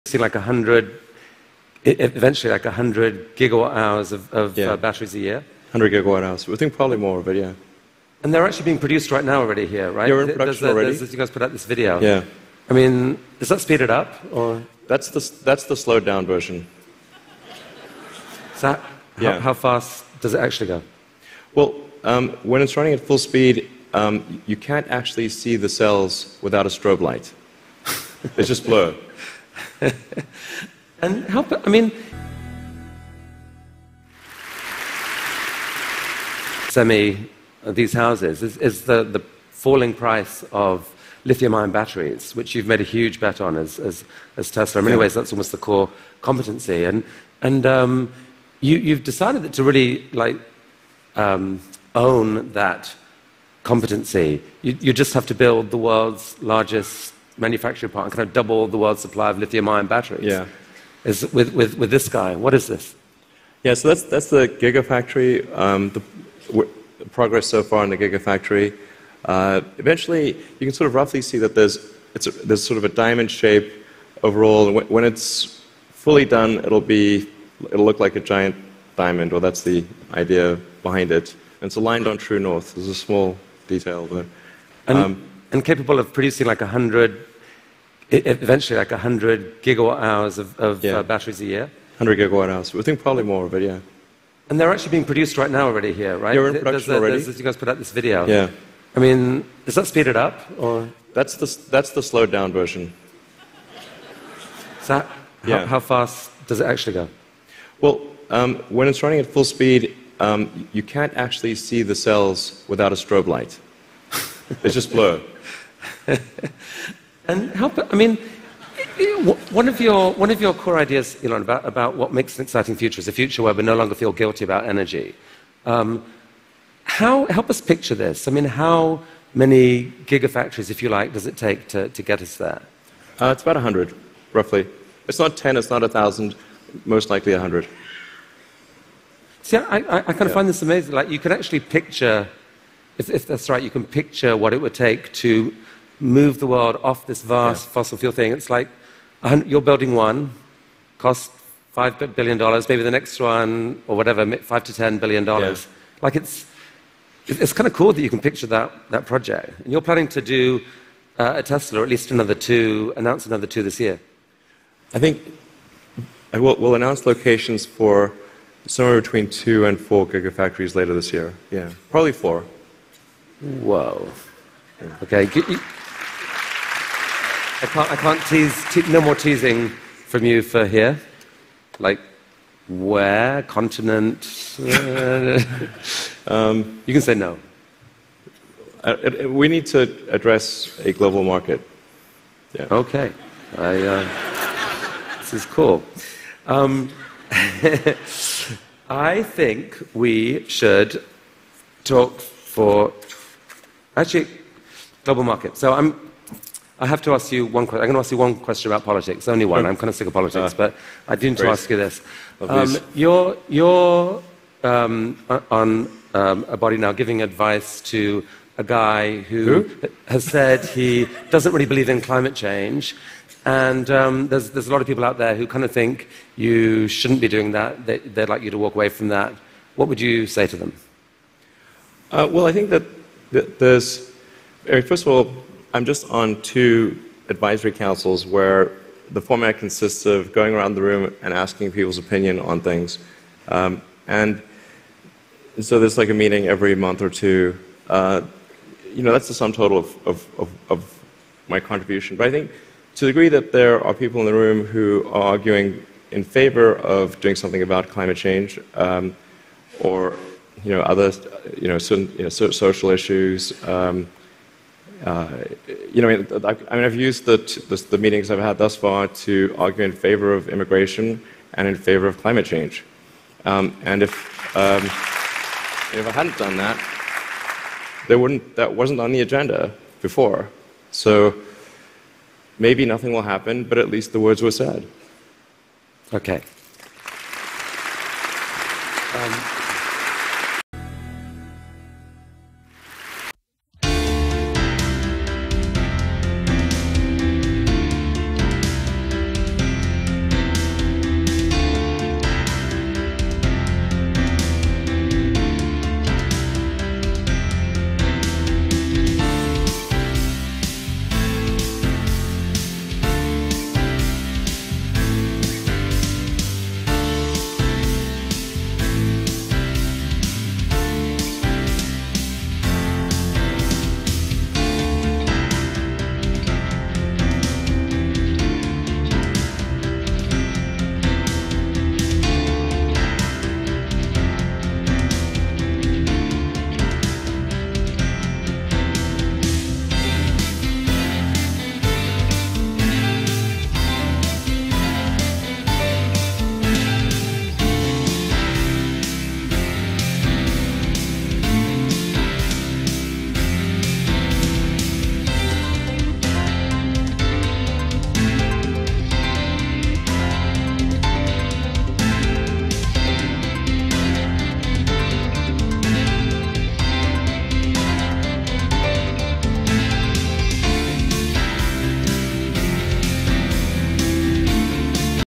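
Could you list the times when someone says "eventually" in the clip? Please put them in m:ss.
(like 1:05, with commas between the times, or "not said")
0:01, 1:09, 1:28.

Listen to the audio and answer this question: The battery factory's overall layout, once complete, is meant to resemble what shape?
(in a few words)
a giant diamond.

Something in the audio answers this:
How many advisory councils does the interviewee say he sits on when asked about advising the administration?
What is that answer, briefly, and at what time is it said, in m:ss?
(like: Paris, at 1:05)
2, at 3:56.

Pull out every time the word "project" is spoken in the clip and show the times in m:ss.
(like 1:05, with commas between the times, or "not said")
2:39.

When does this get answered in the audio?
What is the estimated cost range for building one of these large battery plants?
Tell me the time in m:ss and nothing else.
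2:34.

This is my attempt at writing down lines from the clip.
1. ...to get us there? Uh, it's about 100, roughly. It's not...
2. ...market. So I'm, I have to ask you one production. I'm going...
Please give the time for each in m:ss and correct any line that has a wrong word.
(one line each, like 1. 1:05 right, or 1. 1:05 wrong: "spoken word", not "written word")
1. 2:11 right
2. 3:25 wrong: "question", not "production".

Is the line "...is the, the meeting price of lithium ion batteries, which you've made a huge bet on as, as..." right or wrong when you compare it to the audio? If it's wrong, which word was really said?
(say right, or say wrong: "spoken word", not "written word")
wrong: "falling", not "meeting".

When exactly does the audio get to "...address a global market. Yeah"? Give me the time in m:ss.
3:10.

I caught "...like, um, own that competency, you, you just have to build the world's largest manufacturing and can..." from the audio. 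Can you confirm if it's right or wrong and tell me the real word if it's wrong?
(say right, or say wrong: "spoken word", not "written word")
right.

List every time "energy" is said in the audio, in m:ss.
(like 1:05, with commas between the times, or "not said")
2:04.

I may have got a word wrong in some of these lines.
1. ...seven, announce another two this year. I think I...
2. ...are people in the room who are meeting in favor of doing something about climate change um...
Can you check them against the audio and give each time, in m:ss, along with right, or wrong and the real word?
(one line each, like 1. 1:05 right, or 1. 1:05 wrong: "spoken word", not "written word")
1. 2:42 wrong: "two", not "seven"
2. 4:13 wrong: "arguing", not "meeting".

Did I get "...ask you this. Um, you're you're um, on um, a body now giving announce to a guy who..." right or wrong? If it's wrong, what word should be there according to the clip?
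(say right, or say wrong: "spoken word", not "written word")
wrong: "advice", not "announce".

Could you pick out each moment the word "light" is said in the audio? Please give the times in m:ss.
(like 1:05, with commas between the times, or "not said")
0:26, 1:53.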